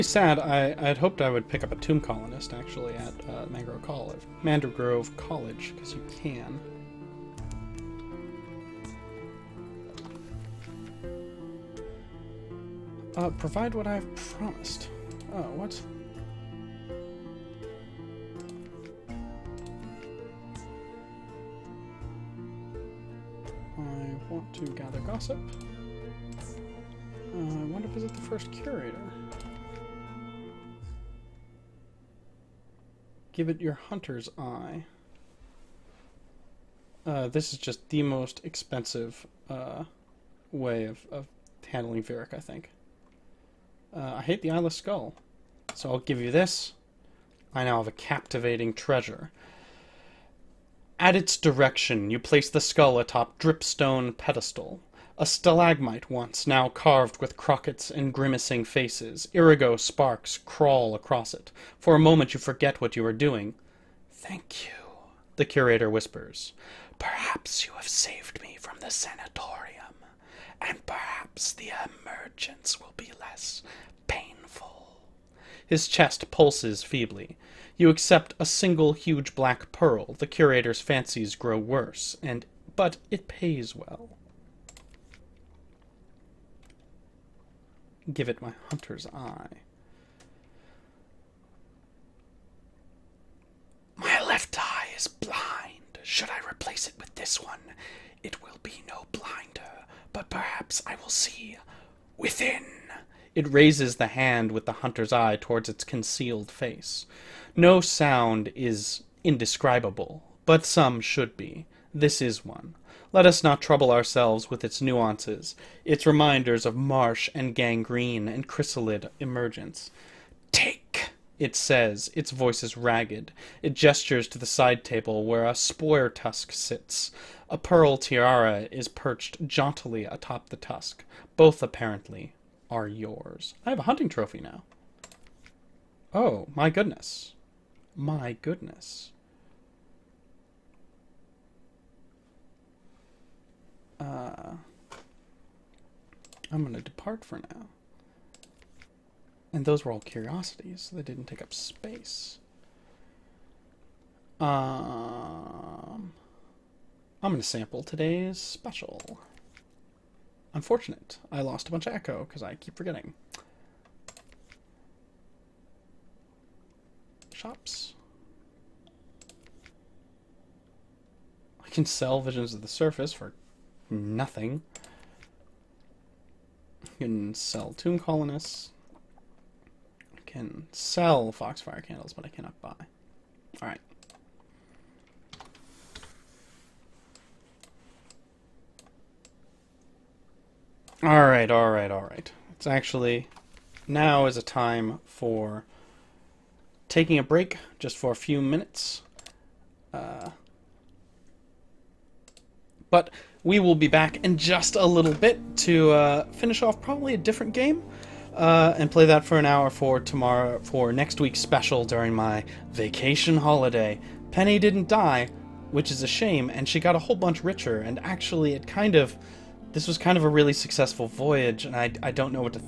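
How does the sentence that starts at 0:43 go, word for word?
Uh, I hate the eyeless skull, so I'll give you this.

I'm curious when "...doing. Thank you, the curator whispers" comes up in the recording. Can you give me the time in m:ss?
1:03.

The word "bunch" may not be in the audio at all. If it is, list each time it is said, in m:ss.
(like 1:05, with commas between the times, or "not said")
2:41, 3:37.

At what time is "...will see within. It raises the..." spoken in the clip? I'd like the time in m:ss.
1:40.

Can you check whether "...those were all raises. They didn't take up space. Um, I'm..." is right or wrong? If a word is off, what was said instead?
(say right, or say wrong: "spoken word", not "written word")
wrong: "curiosities", not "raises".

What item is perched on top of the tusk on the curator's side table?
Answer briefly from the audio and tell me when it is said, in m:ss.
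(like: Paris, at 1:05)
pearl tiara, at 2:07.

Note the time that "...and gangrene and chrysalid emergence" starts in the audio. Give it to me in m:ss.
1:57.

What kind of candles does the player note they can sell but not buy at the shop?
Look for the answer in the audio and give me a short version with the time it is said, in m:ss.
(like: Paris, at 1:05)
foxfire candles, at 3:01.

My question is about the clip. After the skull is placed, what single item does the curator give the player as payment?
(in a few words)
huge black pearl.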